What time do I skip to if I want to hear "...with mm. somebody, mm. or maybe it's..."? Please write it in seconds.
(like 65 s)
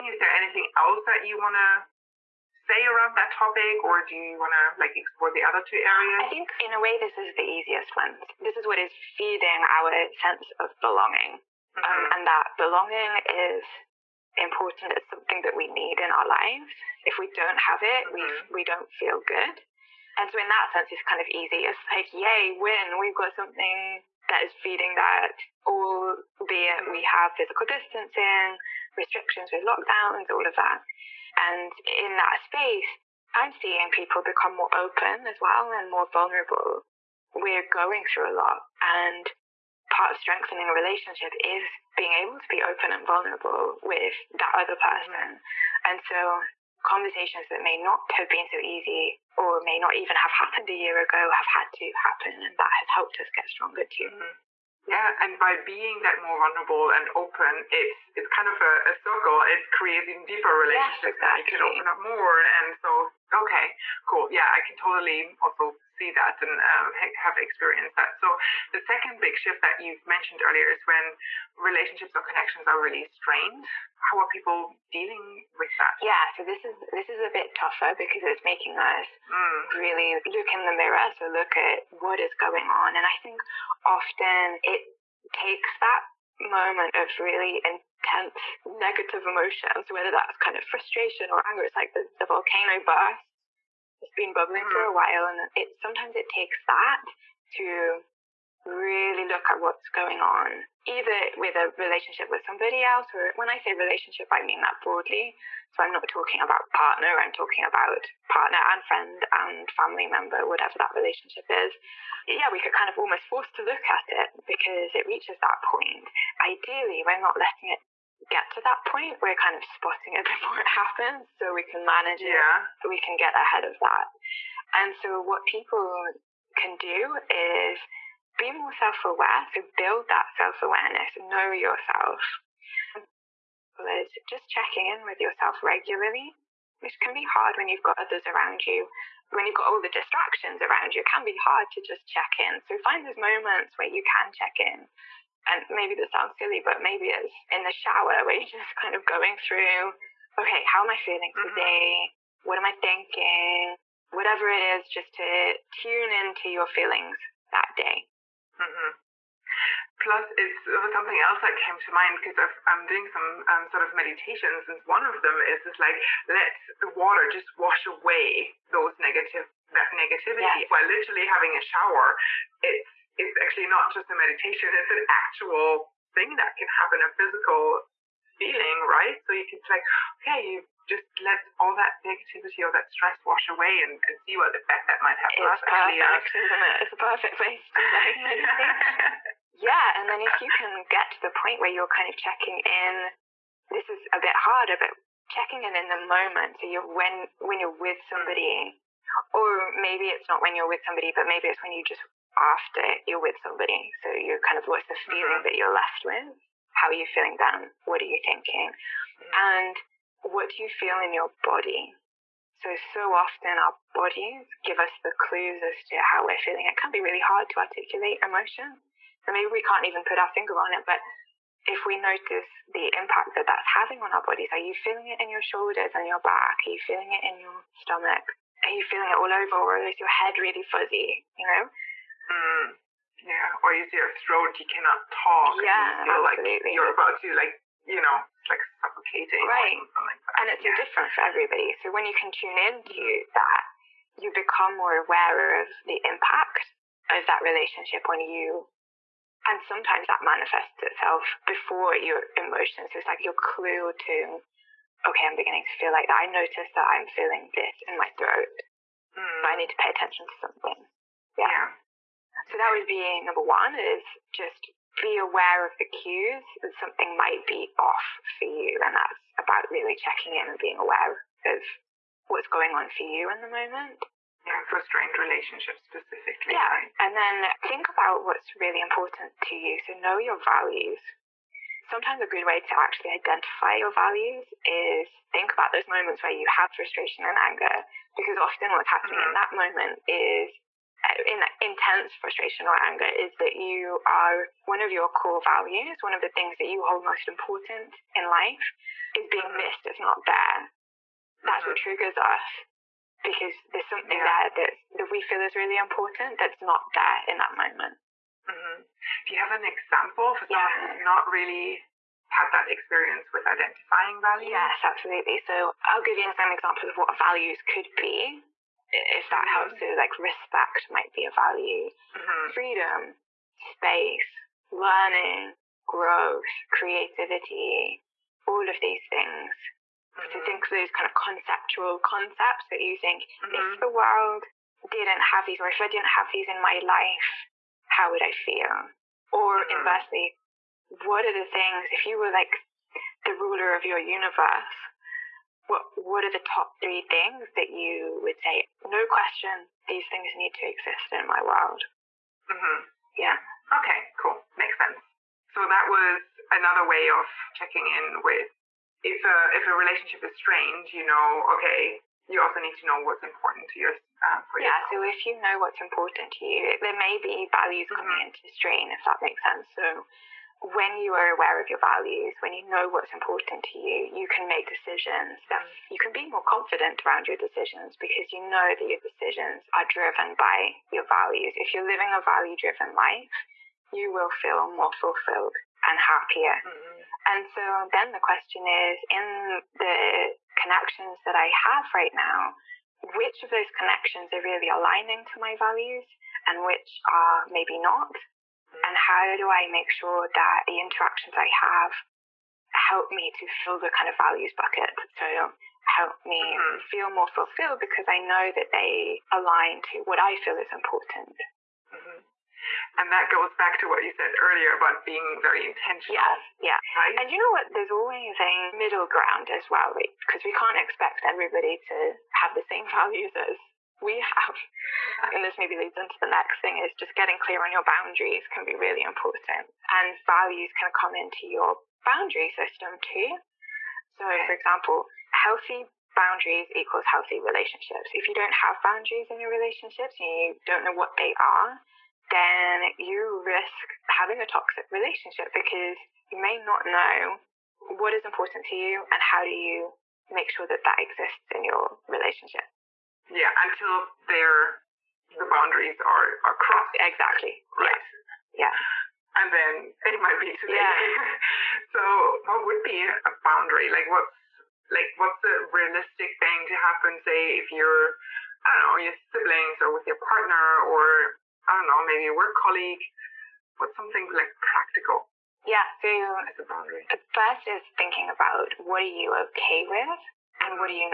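197 s.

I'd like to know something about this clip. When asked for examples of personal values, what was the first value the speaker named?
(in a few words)
Respect.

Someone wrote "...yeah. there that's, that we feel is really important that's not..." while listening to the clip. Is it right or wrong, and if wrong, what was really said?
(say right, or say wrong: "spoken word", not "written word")
right.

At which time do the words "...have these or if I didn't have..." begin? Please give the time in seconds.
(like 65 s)
335 s.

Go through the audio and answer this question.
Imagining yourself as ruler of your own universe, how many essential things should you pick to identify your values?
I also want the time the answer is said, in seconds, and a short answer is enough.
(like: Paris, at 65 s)
3, at 346 s.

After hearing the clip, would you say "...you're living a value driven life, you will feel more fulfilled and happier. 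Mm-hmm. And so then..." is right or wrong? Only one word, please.
right.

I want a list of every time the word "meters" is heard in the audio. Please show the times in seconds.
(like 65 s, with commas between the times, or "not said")
not said.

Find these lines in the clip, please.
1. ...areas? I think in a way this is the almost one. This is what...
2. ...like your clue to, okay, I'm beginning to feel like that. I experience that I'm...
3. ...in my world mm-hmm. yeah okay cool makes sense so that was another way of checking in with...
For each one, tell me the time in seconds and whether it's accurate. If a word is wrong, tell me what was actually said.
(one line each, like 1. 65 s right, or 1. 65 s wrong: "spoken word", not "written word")
1. 5 s wrong: "easiest", not "almost"
2. 253 s wrong: "notice", not "experience"
3. 351 s right.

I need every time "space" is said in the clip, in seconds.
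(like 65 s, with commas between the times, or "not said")
32 s, 323 s.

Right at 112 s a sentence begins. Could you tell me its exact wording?
Yeah, we get kind of almost forced to look at it because it reaches that point.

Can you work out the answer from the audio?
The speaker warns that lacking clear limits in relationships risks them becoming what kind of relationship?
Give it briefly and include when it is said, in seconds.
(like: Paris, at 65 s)
Toxic, at 444 s.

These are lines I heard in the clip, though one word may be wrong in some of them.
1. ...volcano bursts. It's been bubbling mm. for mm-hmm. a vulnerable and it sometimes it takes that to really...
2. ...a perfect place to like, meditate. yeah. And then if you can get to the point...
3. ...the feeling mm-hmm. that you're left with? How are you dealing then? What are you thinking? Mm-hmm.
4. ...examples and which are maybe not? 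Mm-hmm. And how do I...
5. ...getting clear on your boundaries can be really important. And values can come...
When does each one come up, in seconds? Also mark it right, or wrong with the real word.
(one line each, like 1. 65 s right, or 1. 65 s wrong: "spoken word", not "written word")
1. 92 s wrong: "while", not "vulnerable"
2. 186 s right
3. 204 s wrong: "feeling", not "dealing"
4. 395 s wrong: "values", not "examples"
5. 427 s right.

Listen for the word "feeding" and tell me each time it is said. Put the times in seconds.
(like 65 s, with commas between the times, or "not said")
8 s, 24 s.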